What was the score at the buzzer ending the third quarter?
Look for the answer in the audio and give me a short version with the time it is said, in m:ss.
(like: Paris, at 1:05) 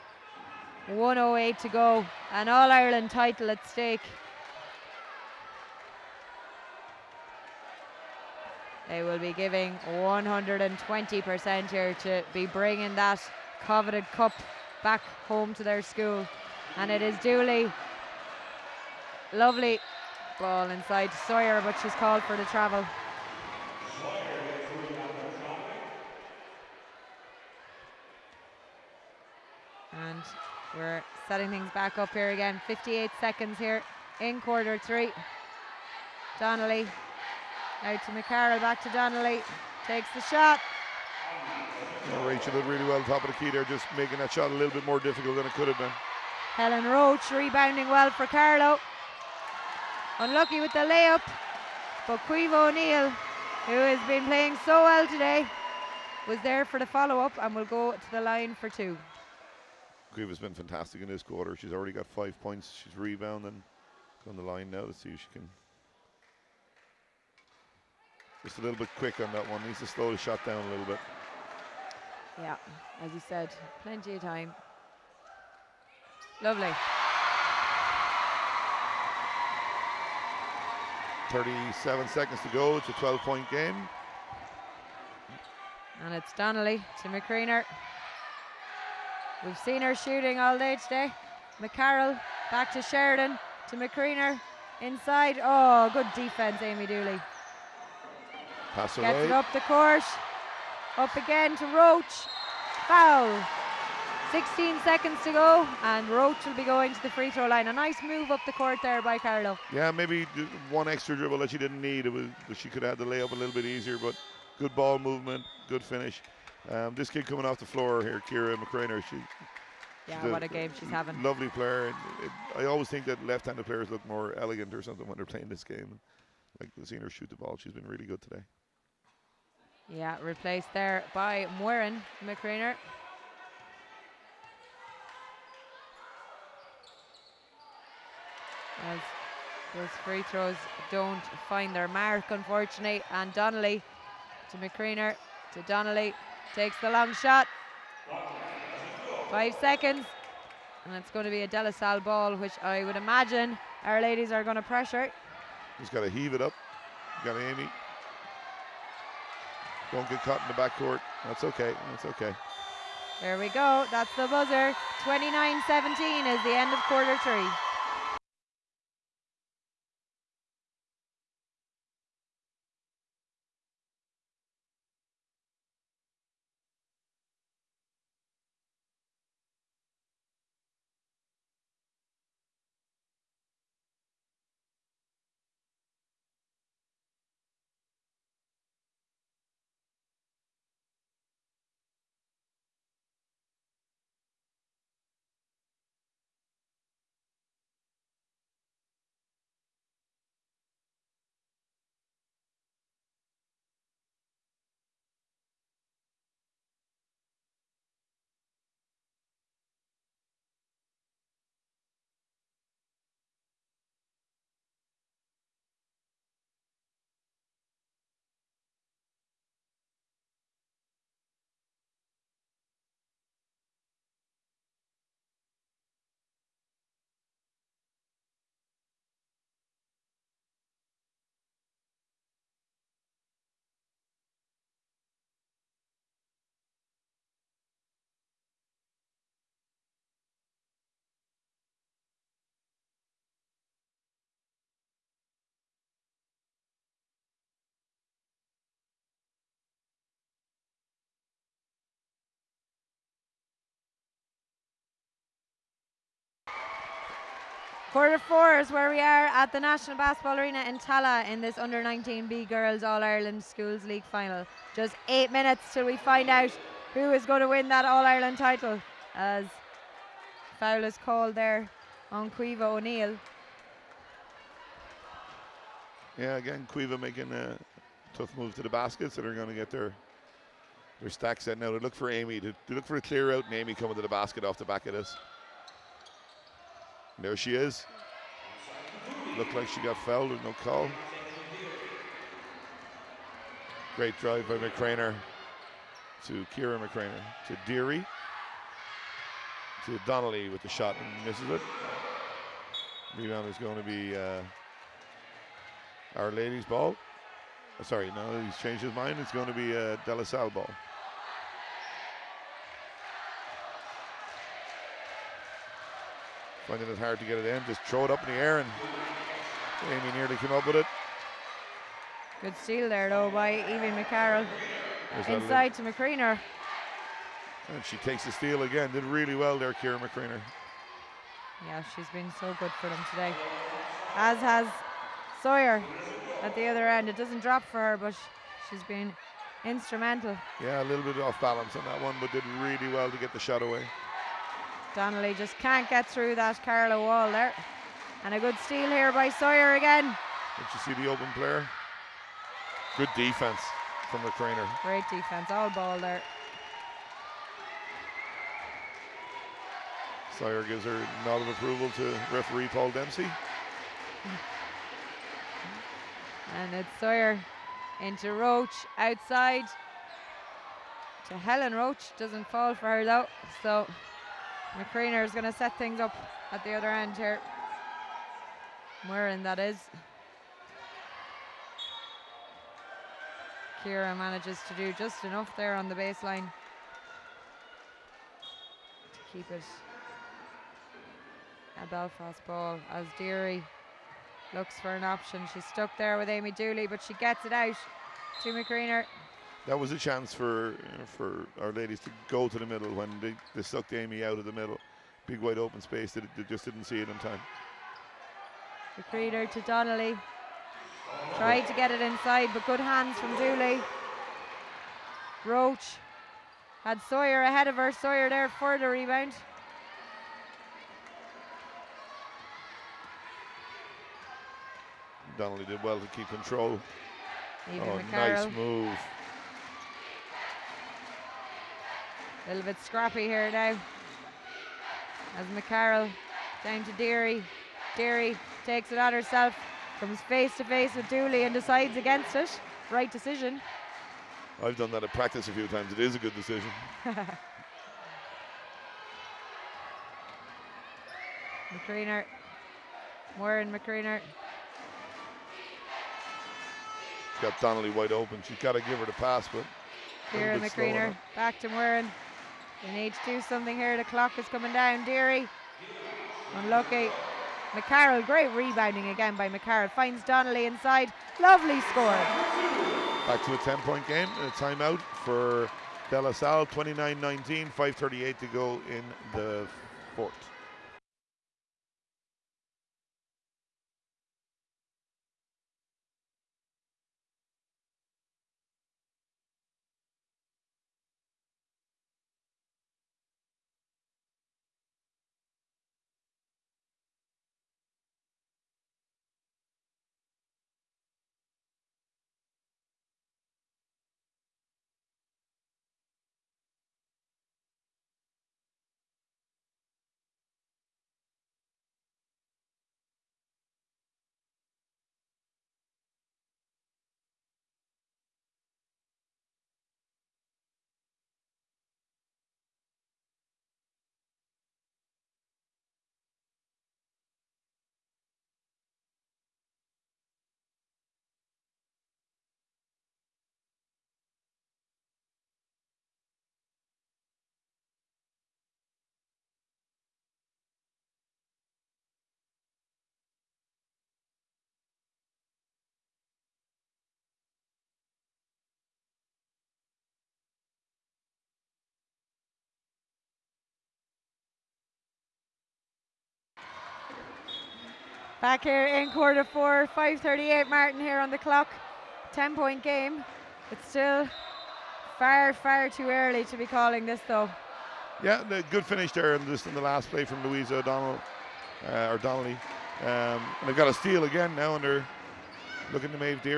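29-17, at 2:45.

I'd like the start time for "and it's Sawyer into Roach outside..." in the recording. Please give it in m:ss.
6:06.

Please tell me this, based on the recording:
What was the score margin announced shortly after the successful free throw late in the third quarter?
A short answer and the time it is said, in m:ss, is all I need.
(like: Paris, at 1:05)
12, at 1:22.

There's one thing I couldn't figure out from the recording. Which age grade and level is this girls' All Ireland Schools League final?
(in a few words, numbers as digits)
under 19B.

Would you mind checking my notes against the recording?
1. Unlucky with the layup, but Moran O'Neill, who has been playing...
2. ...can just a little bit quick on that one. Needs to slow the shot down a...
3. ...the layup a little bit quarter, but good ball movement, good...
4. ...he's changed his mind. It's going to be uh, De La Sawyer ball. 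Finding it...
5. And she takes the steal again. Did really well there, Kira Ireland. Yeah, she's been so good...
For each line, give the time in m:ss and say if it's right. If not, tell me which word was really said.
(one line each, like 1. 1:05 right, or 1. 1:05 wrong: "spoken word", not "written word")
1. 0:50 wrong: "Caoimhe", not "Moran"
2. 1:05 right
3. 1:53 wrong: "easier", not "quarter"
4. 5:08 wrong: "Salle", not "Sawyer"
5. 5:27 wrong: "McCrainer", not "Ireland".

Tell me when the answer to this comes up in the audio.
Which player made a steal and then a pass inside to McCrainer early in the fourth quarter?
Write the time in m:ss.
5:23.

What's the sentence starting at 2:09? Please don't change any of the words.
Yeah, replaced there by Moiran McCrainer.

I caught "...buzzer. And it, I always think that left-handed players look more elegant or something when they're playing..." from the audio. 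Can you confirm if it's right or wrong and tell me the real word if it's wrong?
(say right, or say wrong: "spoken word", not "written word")
wrong: "player", not "buzzer".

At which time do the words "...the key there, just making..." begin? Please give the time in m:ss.
0:43.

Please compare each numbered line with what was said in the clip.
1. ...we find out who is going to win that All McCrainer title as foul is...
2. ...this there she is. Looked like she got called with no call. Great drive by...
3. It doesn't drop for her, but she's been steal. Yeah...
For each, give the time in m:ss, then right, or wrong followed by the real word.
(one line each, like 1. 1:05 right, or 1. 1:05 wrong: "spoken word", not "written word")
1. 4:25 wrong: "Ireland", not "McCrainer"
2. 4:44 wrong: "fouled", not "called"
3. 5:37 wrong: "instrumental", not "steal".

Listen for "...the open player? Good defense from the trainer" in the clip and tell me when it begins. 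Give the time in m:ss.
5:51.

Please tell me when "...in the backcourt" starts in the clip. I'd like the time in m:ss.
2:40.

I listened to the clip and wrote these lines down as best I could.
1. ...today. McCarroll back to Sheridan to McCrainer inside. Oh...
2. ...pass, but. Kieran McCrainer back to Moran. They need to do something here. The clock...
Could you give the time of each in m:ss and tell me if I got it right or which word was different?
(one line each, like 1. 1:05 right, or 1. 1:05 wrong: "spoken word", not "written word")
1. 1:30 right
2. 7:39 right.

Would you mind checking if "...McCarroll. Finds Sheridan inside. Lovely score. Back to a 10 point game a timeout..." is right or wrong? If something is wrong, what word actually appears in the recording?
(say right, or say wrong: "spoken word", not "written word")
wrong: "Donnelly", not "Sheridan".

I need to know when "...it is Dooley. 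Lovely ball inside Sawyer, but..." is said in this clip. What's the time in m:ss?
0:16.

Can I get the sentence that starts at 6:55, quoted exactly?
Roach had Sawyer ahead of her.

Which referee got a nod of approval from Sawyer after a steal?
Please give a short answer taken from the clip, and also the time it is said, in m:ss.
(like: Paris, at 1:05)
Paul Dempsey, at 6:02.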